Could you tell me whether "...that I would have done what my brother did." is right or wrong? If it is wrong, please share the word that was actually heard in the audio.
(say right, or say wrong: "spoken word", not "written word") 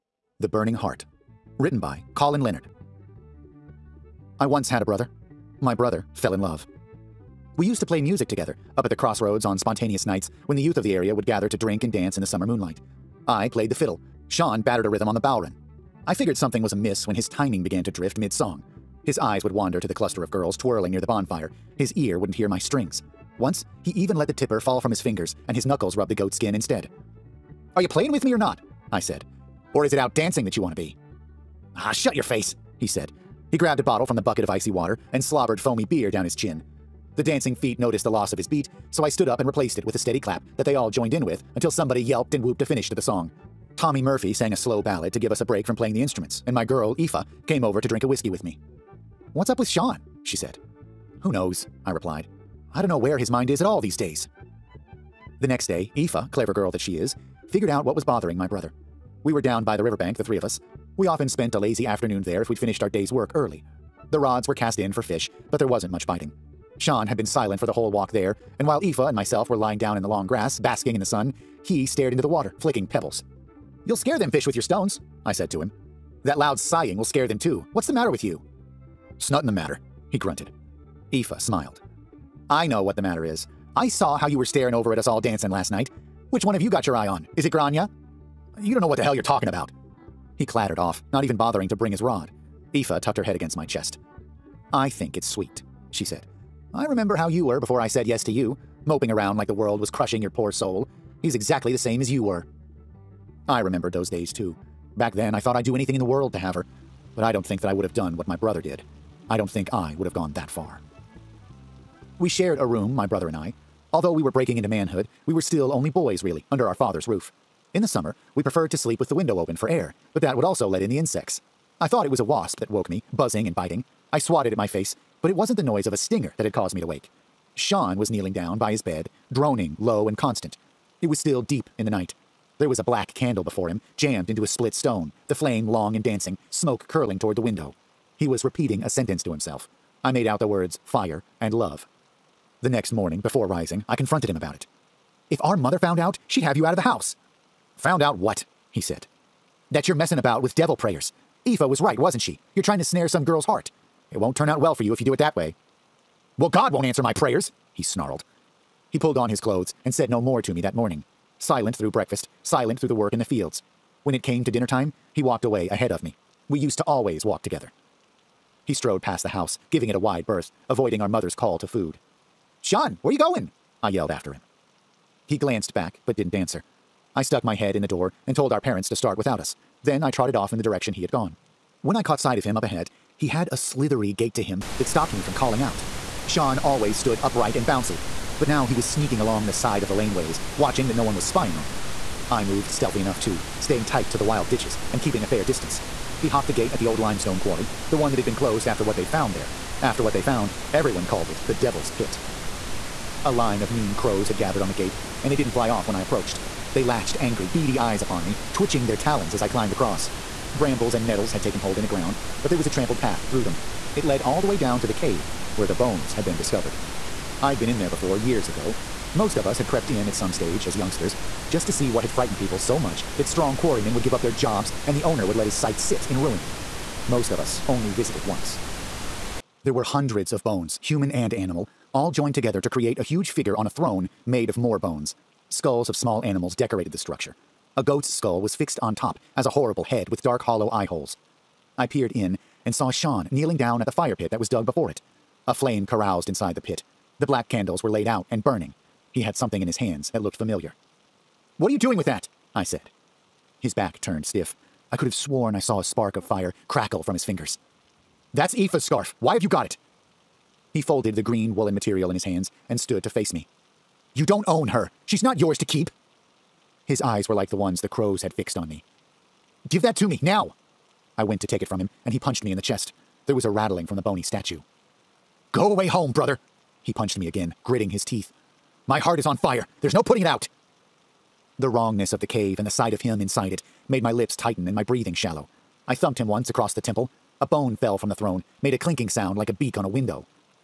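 right.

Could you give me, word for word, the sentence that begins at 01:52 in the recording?
We shared a room, my brother and I.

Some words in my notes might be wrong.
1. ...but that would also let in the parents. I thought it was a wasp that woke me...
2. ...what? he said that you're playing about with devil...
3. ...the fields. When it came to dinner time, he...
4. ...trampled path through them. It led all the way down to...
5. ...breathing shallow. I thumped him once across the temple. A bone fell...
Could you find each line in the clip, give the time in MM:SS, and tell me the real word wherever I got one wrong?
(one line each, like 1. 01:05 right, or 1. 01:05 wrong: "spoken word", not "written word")
1. 02:00 wrong: "insects", not "parents"
2. 02:28 wrong: "messing", not "playing"
3. 02:43 right
4. 03:32 right
5. 04:44 right.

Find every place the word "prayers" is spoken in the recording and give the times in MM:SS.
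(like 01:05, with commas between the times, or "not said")
02:30, 02:37.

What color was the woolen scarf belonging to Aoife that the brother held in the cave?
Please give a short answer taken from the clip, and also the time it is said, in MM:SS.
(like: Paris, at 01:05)
Green, at 04:21.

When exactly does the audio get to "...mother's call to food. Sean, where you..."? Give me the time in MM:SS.
02:51.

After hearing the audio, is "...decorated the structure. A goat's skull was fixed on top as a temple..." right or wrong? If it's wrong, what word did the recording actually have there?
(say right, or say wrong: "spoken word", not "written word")
wrong: "horrible", not "temple".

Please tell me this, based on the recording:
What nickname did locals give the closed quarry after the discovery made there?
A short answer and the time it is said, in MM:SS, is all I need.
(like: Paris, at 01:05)
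The Devil's Pit, at 03:21.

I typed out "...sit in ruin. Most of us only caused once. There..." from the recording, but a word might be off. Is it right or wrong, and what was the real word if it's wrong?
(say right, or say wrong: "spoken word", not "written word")
wrong: "visited", not "caused".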